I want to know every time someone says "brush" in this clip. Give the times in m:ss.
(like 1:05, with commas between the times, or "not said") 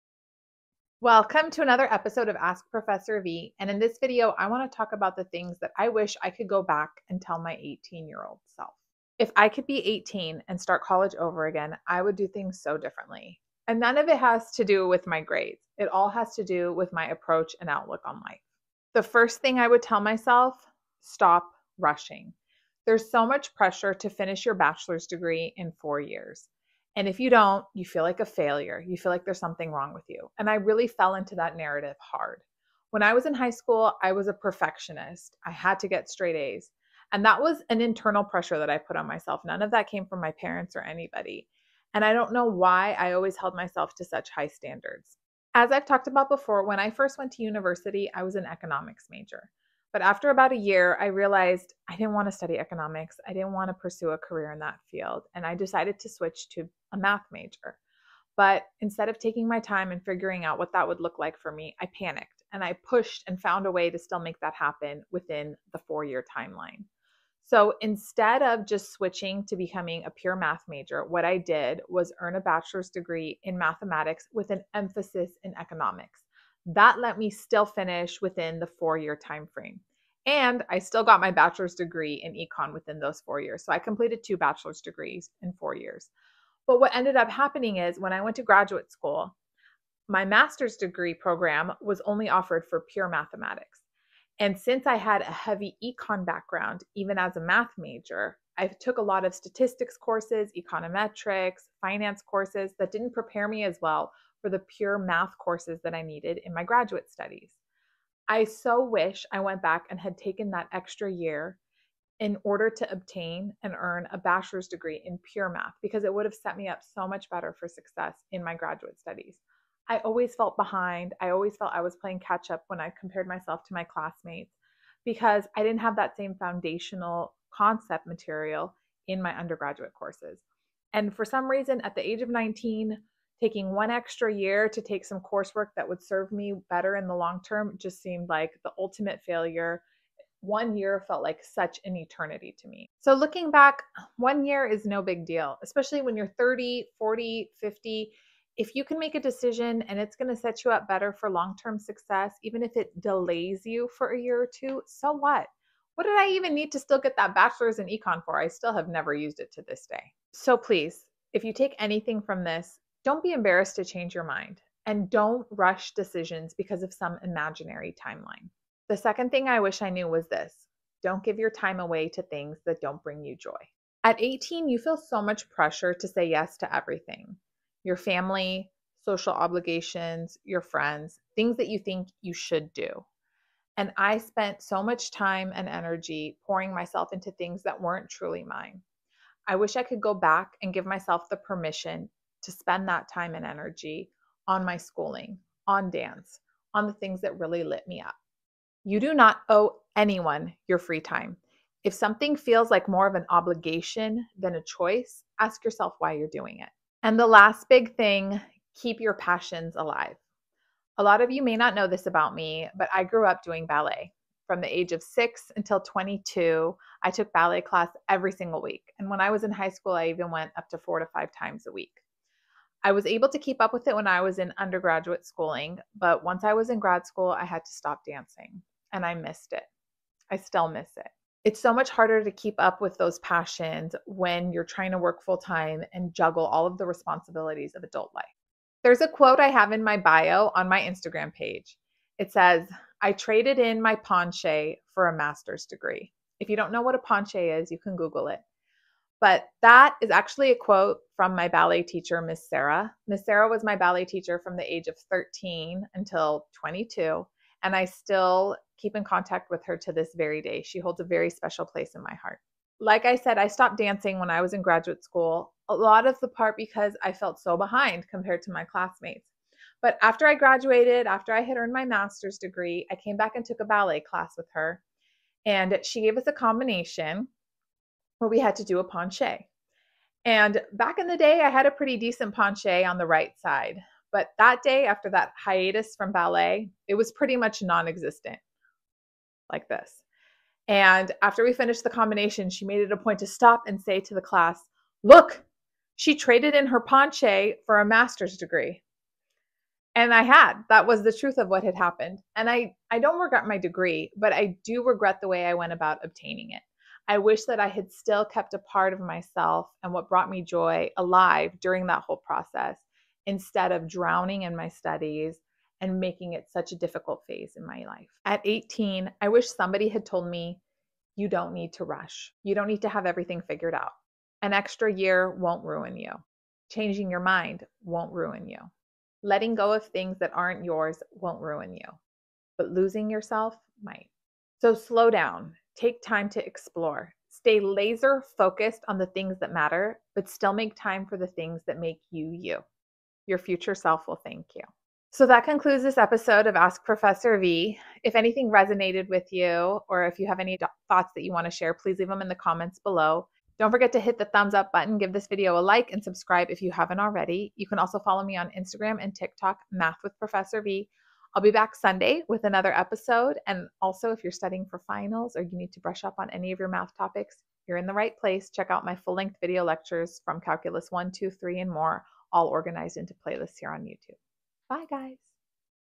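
6:05.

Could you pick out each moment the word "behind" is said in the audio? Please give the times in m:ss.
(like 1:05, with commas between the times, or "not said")
2:00, 4:27.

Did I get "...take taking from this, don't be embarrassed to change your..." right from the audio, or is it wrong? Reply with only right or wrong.
wrong.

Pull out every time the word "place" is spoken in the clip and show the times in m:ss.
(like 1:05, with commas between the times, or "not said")
4:21, 6:08.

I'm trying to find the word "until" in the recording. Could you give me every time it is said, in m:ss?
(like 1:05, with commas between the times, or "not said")
3:35, 4:15.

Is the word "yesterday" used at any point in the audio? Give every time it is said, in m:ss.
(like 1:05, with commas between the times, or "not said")
not said.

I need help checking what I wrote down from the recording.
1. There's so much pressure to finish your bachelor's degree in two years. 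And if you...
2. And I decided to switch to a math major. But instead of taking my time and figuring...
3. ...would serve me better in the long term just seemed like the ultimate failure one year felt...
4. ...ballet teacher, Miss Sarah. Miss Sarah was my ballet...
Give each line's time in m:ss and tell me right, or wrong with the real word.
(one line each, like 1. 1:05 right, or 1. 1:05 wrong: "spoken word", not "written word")
1. 0:22 wrong: "four", not "two"
2. 0:55 right
3. 2:15 right
4. 4:11 right.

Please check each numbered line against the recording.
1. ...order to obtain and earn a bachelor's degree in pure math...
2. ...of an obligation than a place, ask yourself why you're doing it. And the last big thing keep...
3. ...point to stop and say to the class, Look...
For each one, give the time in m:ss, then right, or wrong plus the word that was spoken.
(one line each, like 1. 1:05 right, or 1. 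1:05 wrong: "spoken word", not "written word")
1. 1:52 right
2. 3:23 wrong: "choice", not "place"
3. 4:52 right.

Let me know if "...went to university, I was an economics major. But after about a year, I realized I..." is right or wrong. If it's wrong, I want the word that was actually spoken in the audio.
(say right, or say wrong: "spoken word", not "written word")
right.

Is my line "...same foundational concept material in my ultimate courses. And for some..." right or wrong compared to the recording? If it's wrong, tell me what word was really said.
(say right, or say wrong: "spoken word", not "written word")
wrong: "undergraduate", not "ultimate".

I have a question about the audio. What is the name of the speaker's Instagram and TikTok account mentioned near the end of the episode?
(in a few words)
Math with Professor V.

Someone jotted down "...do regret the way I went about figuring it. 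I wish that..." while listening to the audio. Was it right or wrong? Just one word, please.
wrong.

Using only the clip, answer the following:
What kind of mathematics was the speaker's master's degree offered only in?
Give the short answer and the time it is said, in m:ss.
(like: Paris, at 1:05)
Pure mathematics, at 1:32.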